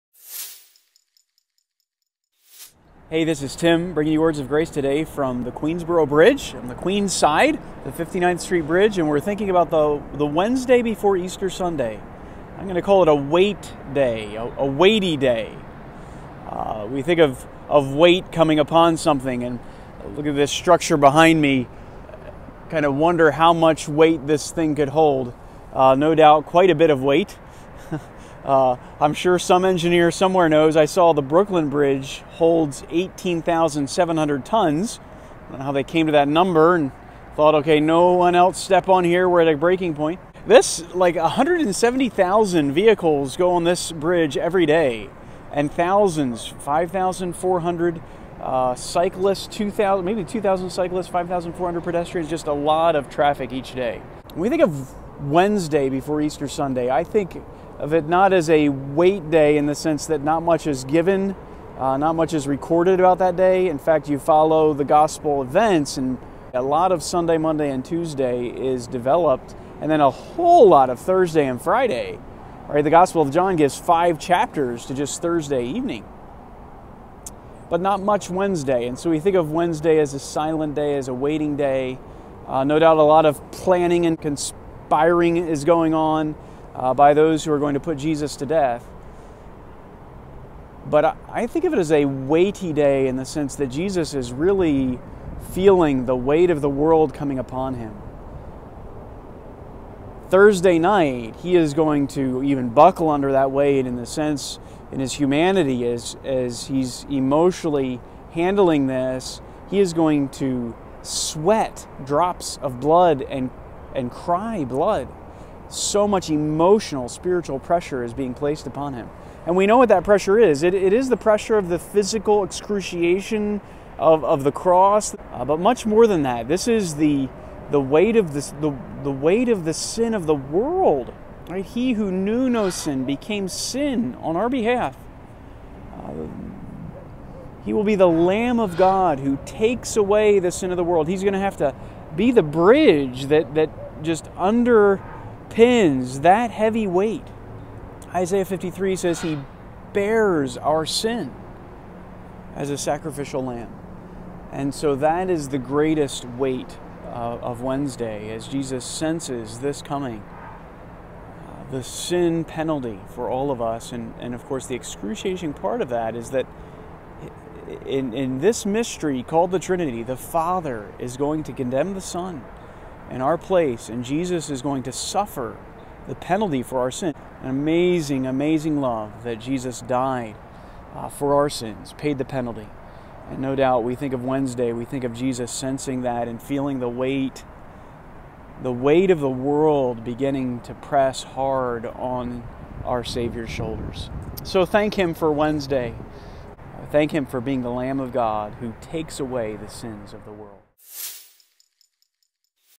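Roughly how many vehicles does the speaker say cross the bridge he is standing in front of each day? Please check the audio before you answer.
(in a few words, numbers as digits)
170,000.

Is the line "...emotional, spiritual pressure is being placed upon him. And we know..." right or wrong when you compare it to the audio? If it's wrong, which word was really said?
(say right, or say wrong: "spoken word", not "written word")
right.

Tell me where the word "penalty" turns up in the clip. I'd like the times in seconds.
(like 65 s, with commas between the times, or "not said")
162 s, 176 s, 182 s.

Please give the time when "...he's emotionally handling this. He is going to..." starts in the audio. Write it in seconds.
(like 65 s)
106 s.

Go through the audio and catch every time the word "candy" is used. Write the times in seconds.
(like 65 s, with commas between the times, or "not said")
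not said.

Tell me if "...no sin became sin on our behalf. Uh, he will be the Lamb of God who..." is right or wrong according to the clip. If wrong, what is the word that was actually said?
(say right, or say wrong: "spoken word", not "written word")
right.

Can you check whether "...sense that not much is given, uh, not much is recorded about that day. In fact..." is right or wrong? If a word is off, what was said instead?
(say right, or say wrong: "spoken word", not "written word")
right.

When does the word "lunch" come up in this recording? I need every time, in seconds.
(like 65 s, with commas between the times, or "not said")
not said.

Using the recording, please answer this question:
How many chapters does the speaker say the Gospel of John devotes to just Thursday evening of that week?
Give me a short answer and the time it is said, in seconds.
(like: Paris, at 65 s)
5, at 73 s.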